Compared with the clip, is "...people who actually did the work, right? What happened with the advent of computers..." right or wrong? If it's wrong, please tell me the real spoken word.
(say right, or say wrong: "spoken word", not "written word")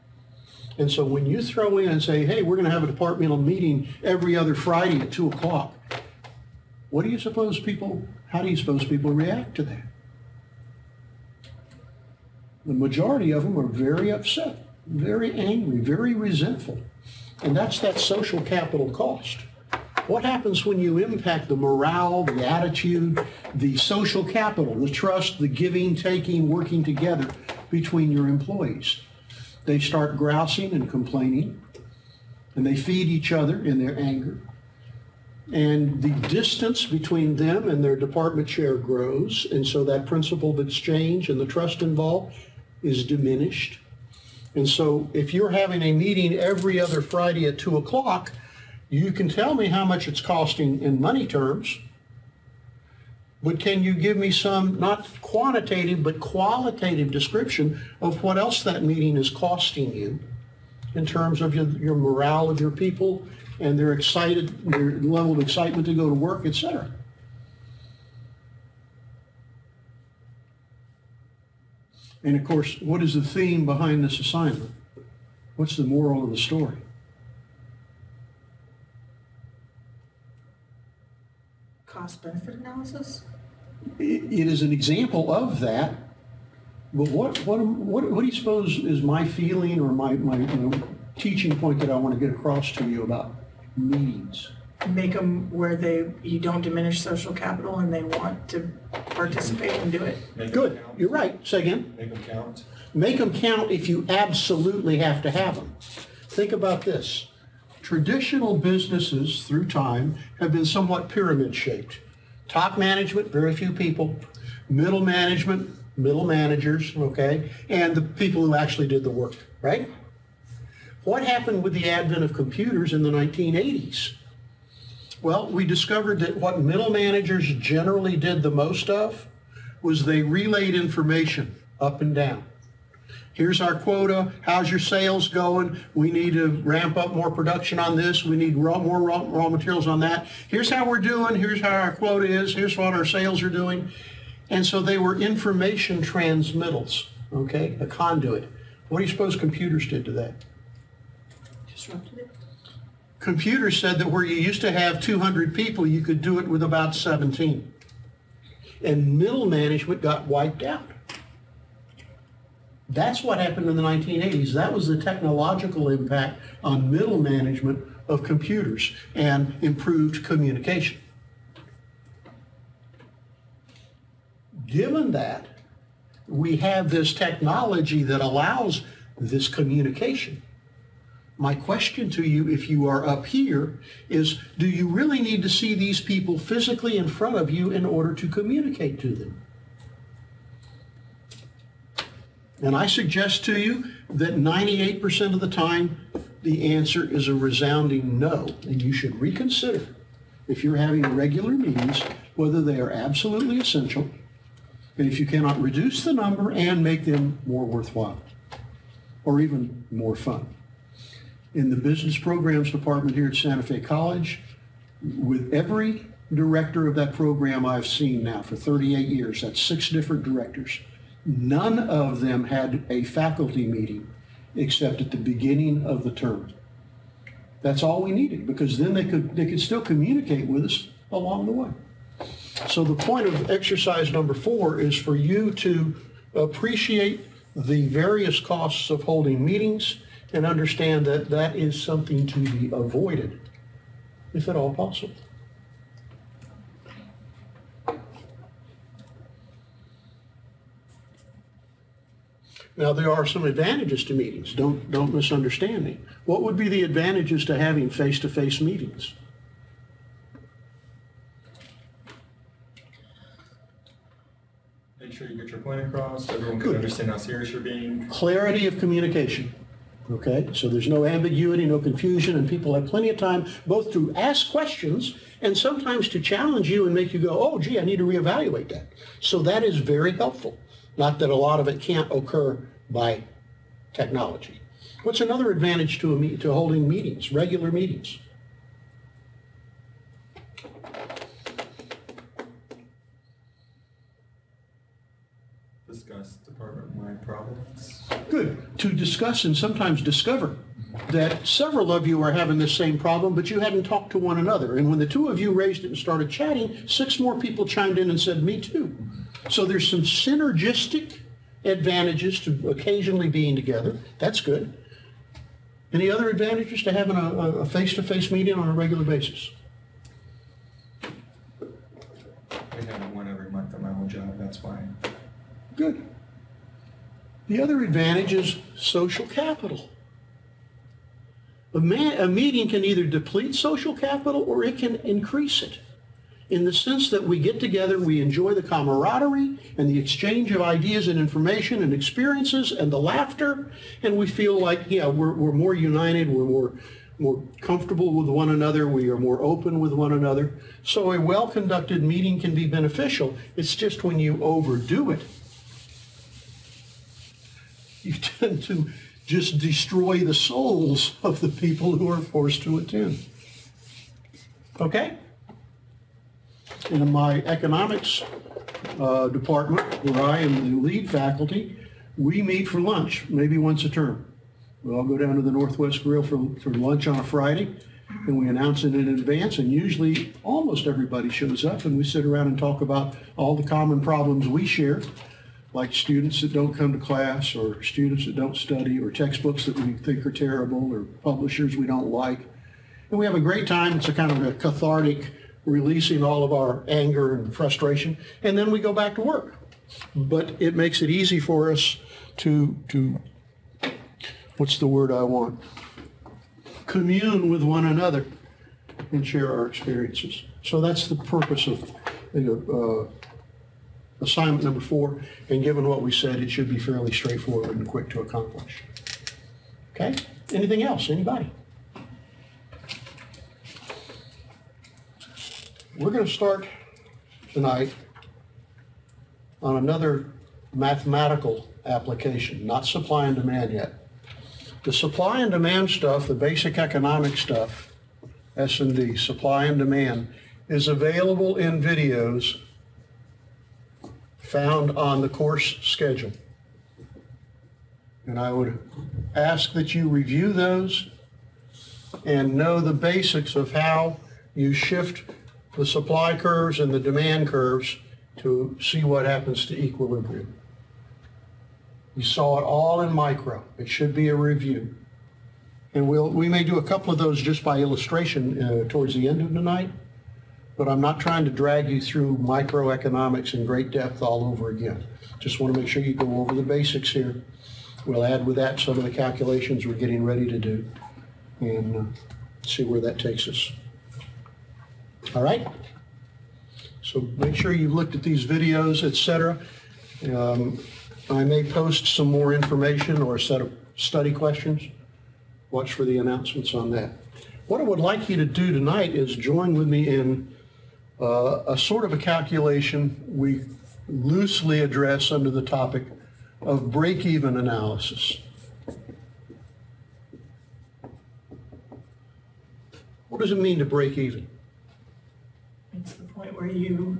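right.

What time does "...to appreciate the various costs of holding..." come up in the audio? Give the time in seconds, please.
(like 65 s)
235 s.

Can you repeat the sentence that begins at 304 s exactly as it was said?
And when the two of you raised it and started chatting, six more people chimed in and said, me too.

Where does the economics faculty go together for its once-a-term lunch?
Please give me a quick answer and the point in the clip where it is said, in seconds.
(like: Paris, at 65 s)
Northwest Grill, at 375 s.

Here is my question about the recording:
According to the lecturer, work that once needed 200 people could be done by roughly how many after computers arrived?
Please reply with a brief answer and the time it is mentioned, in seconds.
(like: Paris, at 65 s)
17, at 156 s.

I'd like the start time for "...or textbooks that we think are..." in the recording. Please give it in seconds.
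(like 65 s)
388 s.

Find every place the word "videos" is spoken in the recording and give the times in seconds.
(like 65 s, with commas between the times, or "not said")
441 s, 488 s.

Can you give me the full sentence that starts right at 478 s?
We'll add with that some of the calculations we're getting ready to do and uh, see where that takes us.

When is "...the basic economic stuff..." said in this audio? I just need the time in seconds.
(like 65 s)
436 s.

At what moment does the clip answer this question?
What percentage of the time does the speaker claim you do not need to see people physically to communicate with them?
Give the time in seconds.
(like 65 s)
194 s.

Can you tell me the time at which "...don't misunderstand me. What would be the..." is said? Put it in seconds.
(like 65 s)
254 s.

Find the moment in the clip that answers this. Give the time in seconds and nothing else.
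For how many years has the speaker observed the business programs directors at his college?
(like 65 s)
218 s.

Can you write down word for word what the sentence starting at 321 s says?
I have one every month at my whole job.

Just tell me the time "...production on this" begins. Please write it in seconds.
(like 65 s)
137 s.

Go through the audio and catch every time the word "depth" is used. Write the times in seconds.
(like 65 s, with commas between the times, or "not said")
473 s.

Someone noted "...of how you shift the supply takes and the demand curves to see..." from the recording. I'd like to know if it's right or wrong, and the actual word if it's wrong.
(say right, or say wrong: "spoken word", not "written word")
wrong: "curves", not "takes".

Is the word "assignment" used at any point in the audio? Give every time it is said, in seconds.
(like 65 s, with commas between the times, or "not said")
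74 s, 414 s.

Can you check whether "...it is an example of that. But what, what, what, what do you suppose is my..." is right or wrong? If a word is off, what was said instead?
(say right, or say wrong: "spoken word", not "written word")
right.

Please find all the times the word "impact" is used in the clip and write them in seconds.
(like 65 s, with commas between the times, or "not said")
20 s, 165 s.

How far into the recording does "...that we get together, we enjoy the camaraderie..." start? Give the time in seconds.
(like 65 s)
337 s.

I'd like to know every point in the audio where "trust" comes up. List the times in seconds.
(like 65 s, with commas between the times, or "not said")
24 s, 41 s.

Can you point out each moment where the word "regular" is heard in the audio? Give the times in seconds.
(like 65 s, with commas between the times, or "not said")
201 s, 287 s, 318 s.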